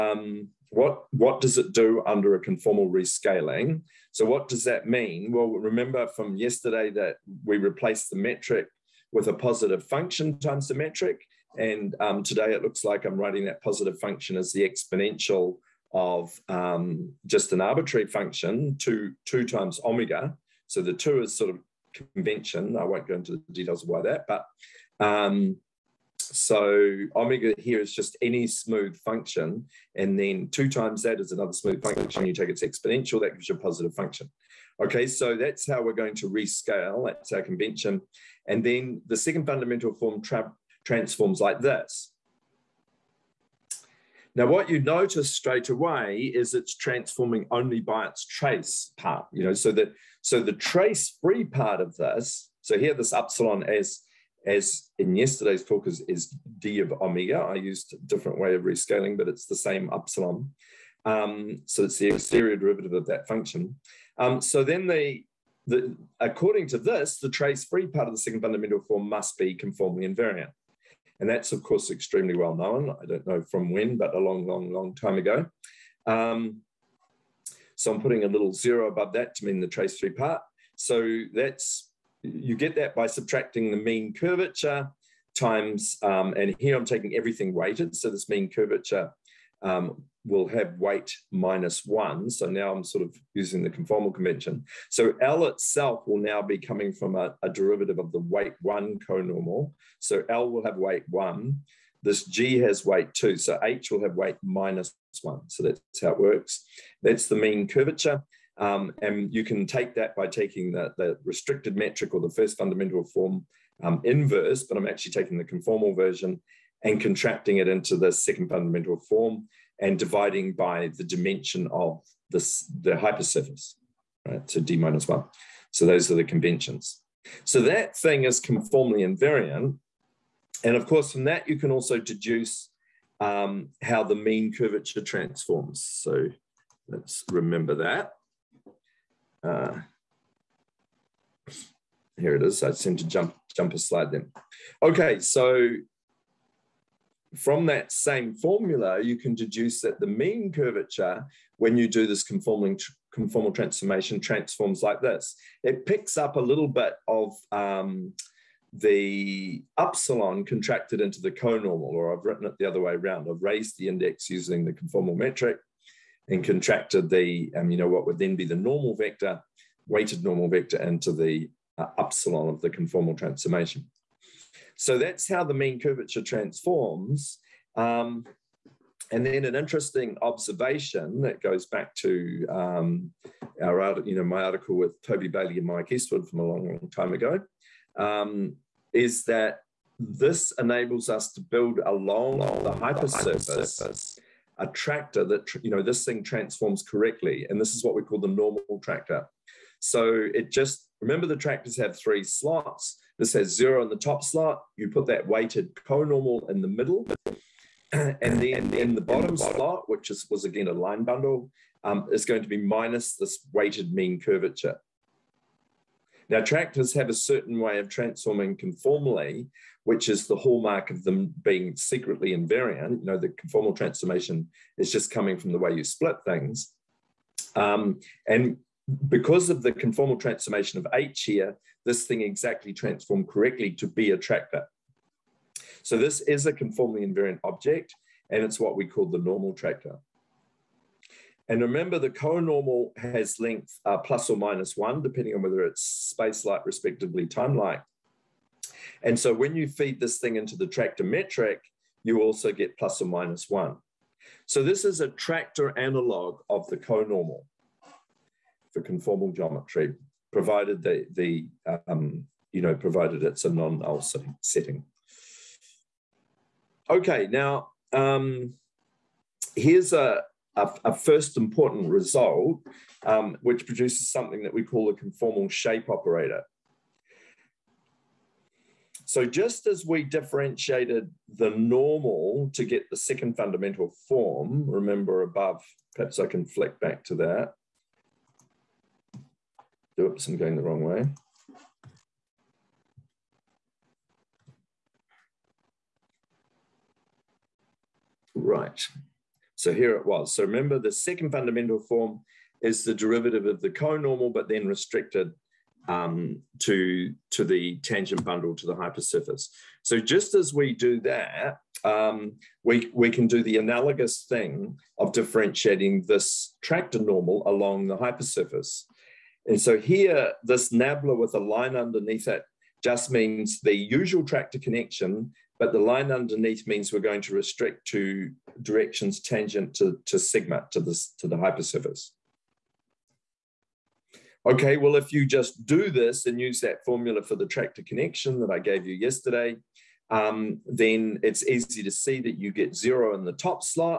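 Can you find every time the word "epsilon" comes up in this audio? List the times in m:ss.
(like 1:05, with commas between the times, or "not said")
0:53, 0:59.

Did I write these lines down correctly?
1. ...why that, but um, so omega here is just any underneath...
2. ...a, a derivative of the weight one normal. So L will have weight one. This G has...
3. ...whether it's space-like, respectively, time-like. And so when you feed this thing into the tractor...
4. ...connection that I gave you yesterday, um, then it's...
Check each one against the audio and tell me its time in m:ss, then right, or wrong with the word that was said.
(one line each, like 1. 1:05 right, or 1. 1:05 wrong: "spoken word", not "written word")
1. 0:23 wrong: "smooth", not "underneath"
2. 1:37 wrong: "conormal", not "normal"
3. 4:05 right
4. 5:37 right.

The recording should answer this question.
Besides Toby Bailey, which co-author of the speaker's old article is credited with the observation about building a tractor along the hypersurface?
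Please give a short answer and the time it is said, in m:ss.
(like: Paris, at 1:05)
Mike Eastwood, at 3:05.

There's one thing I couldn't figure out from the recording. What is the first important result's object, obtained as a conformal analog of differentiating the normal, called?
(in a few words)
conformal shape operator.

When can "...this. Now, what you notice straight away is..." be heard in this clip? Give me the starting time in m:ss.
0:41.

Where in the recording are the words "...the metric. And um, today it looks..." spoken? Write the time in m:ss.
0:10.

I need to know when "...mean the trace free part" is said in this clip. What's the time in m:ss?
1:19.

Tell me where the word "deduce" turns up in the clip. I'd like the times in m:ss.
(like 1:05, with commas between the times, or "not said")
2:11, 2:29.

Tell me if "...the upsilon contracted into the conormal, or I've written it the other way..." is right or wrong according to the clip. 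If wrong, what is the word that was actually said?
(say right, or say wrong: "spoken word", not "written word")
right.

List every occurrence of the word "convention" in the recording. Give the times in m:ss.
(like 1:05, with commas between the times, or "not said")
0:22, 0:37, 1:34, 2:06.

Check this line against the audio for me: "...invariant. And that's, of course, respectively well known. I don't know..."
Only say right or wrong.
wrong.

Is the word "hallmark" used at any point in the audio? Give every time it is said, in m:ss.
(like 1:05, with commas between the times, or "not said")
3:40.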